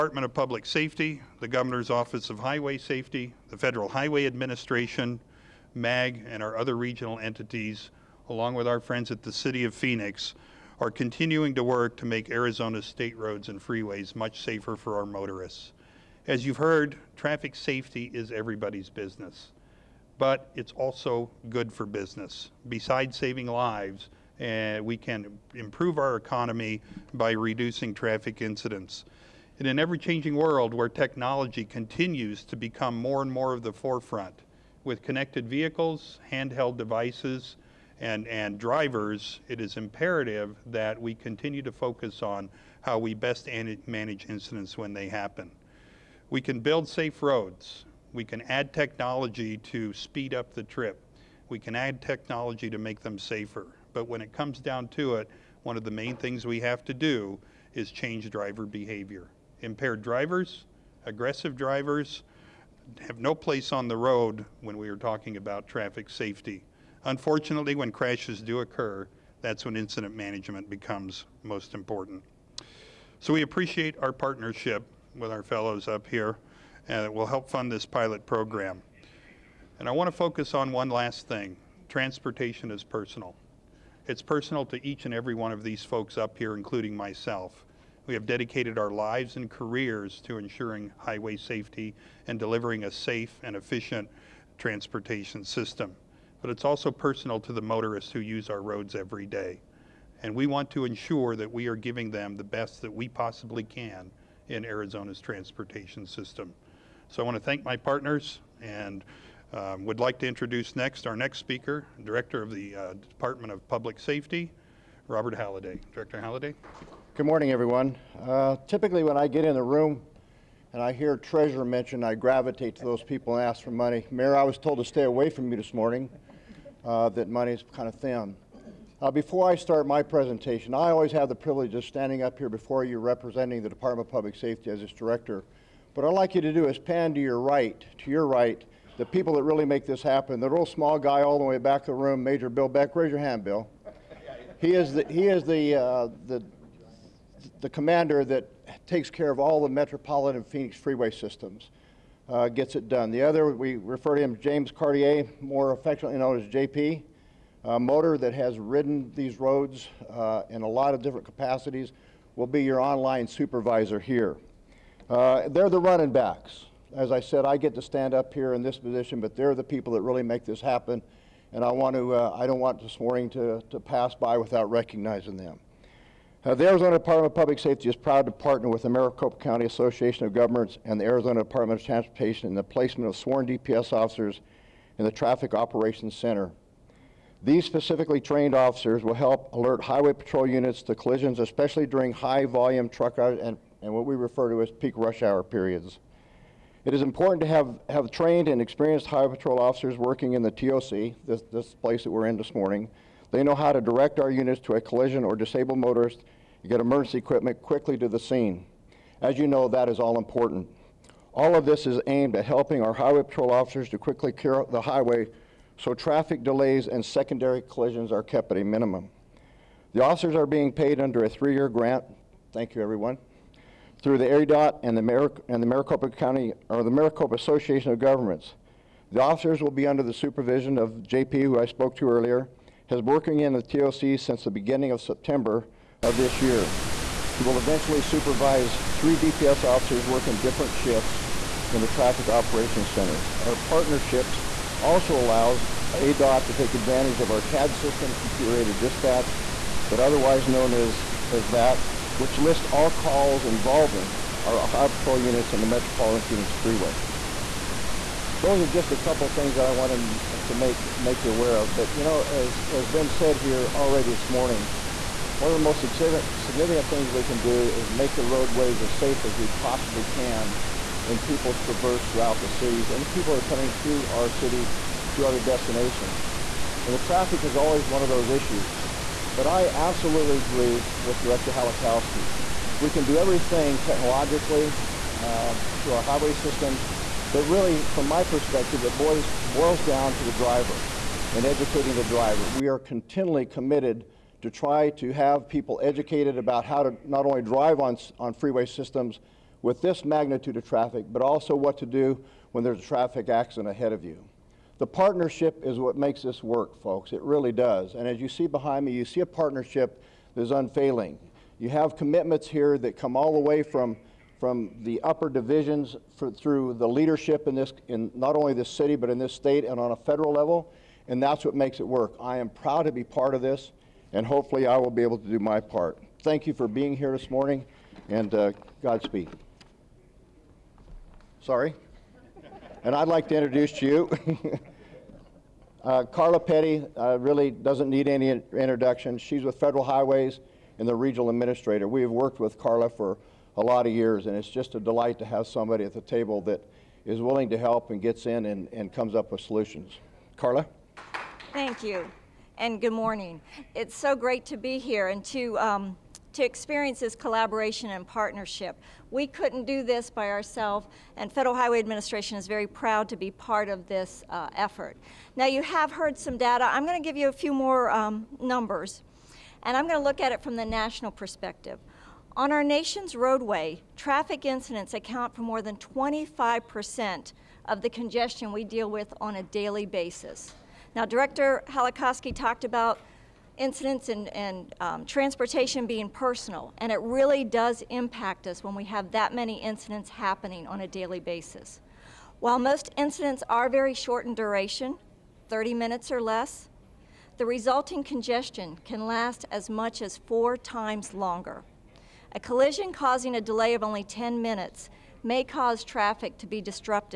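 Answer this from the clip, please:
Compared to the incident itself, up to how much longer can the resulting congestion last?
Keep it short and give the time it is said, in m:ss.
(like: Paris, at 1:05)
4 times longer, at 6:40.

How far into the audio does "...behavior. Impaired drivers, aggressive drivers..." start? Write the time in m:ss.
0:58.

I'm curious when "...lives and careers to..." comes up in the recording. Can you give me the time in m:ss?
1:28.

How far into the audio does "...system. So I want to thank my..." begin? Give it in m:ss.
1:46.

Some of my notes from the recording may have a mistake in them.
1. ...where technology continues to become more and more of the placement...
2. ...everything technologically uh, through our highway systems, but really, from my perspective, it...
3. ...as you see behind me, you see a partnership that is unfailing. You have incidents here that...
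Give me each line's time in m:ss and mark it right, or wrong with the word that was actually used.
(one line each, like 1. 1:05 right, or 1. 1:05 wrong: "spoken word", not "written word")
1. 0:30 wrong: "forefront", not "placement"
2. 4:43 right
3. 5:08 wrong: "commitments", not "incidents".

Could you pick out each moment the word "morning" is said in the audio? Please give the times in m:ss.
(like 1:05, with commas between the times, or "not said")
1:57, 2:05, 2:52, 3:22, 4:24, 5:27, 5:52.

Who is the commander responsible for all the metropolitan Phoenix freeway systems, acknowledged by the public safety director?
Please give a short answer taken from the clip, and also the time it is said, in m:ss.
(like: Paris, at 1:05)
Major Bill Beck, at 2:22.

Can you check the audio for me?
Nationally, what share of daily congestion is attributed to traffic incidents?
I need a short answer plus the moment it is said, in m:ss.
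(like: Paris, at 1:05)
more than 25%, at 6:15.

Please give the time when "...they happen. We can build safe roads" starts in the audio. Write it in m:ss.
0:44.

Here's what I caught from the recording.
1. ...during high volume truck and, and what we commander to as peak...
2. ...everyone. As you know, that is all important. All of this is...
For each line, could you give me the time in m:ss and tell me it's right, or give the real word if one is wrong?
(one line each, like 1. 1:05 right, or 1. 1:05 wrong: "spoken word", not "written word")
1. 3:11 wrong: "refer", not "commander"
2. 3:28 wrong: "scene", not "everyone".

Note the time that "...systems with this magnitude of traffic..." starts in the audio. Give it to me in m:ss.
4:58.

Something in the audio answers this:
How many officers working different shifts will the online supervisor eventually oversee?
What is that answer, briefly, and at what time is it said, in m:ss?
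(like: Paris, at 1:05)
3, at 3:58.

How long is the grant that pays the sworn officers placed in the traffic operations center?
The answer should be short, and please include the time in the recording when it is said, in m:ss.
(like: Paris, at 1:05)
3 years, at 3:41.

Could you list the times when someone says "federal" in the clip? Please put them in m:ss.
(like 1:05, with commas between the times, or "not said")
0:03, 5:19, 5:39, 6:01.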